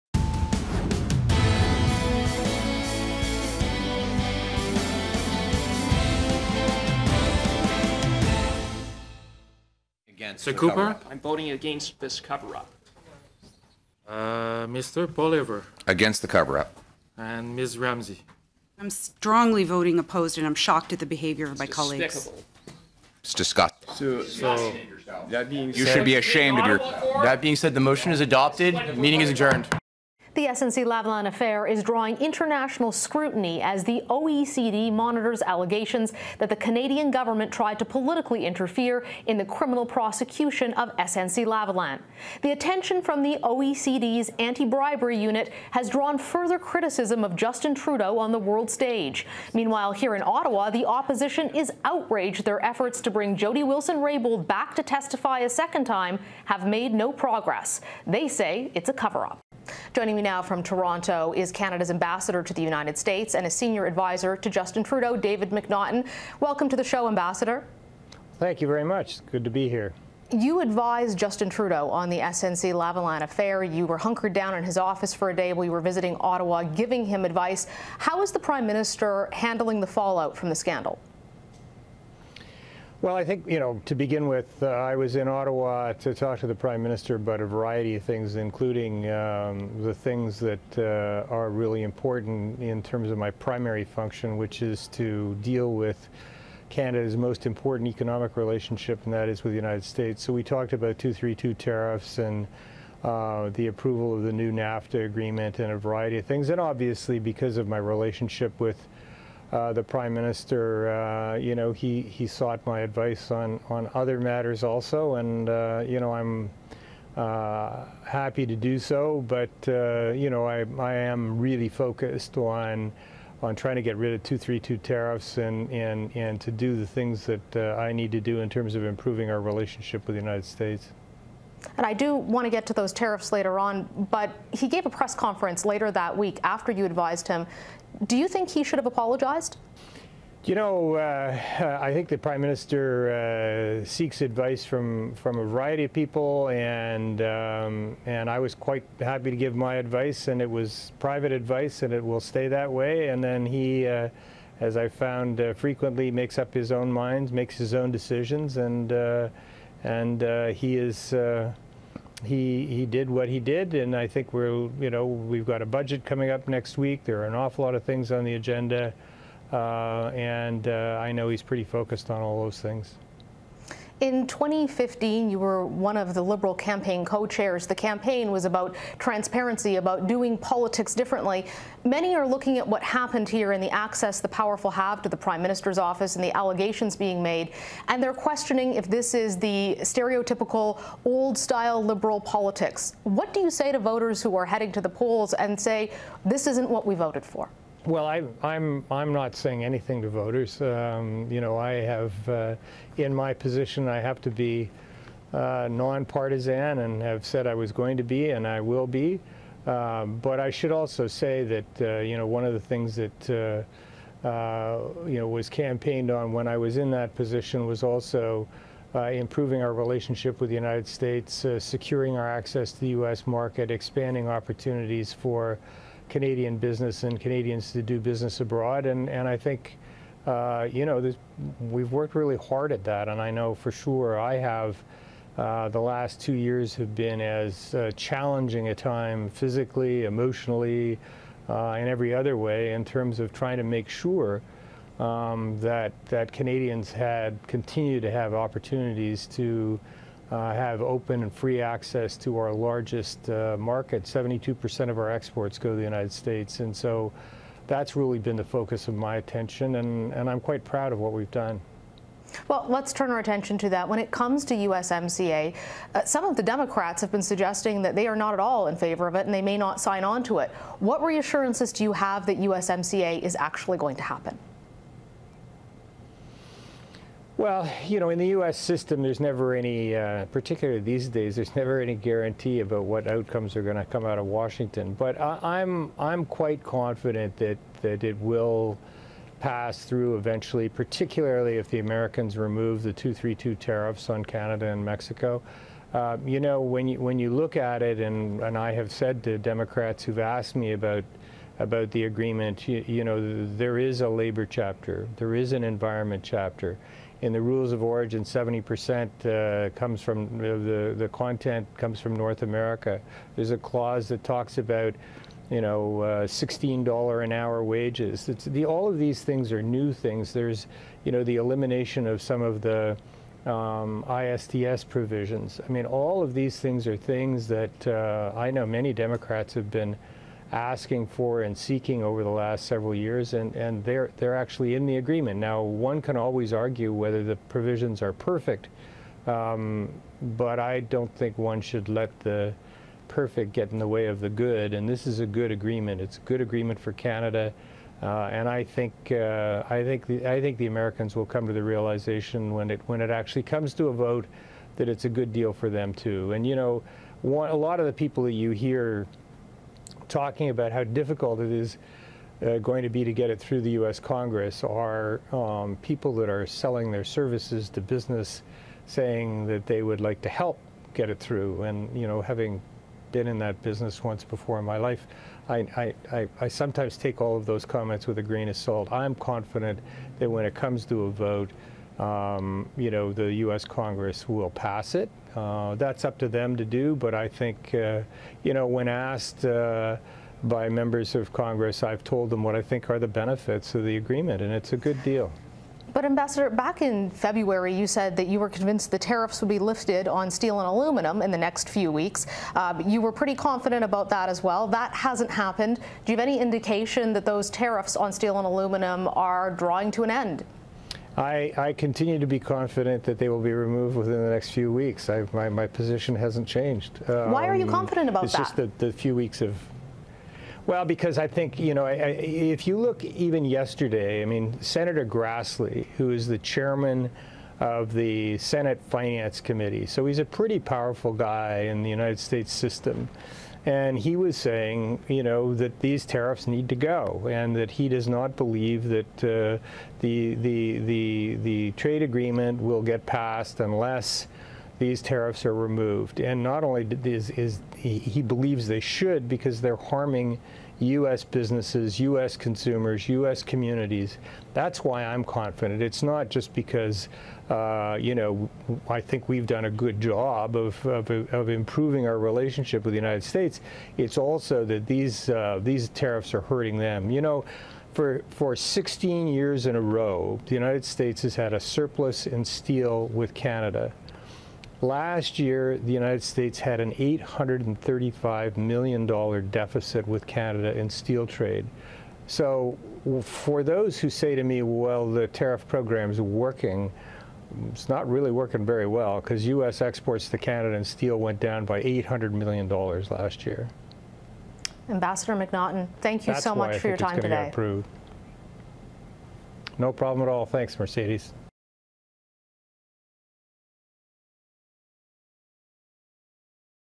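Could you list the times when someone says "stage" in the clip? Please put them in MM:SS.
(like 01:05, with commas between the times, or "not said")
00:48.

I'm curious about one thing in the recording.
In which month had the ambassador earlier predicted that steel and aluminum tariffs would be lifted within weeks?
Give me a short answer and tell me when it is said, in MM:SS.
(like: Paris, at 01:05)
February, at 06:37.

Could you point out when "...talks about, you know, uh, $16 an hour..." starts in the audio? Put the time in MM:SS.
05:14.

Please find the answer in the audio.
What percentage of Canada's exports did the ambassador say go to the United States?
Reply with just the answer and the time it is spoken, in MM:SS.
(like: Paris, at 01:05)
72%, at 04:14.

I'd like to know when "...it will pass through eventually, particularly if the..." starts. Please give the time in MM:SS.
04:48.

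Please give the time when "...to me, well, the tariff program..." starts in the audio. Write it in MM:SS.
08:04.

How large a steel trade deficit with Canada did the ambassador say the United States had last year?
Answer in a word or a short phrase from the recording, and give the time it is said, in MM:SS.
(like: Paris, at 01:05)
$835 million, at 07:56.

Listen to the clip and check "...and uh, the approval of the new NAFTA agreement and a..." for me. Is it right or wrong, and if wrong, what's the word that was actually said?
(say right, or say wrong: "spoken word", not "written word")
right.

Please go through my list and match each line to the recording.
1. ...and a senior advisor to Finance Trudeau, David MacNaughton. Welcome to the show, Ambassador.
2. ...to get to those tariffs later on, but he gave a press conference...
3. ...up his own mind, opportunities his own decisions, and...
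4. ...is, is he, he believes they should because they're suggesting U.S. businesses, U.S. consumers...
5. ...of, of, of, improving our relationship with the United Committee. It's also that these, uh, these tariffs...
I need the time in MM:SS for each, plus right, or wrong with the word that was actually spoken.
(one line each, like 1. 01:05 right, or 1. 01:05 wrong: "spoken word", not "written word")
1. 01:03 wrong: "Justin", not "Finance"
2. 02:12 right
3. 02:36 wrong: "makes", not "opportunities"
4. 07:27 wrong: "harming", not "suggesting"
5. 07:40 wrong: "States", not "Committee".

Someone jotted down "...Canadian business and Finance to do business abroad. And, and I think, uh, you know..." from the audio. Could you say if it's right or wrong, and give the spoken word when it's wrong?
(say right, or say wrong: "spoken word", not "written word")
wrong: "Canadians", not "Finance".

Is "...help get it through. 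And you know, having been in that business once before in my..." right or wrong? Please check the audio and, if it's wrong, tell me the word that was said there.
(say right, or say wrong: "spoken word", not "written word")
right.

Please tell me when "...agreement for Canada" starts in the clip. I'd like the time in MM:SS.
05:46.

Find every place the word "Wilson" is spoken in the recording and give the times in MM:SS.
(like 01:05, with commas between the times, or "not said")
00:53.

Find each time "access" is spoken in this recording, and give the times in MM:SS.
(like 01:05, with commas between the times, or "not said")
03:03, 03:42, 04:11.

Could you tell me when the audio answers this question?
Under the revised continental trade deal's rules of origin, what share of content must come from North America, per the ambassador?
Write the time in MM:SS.
05:08.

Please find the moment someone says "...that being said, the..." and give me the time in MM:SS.
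00:27.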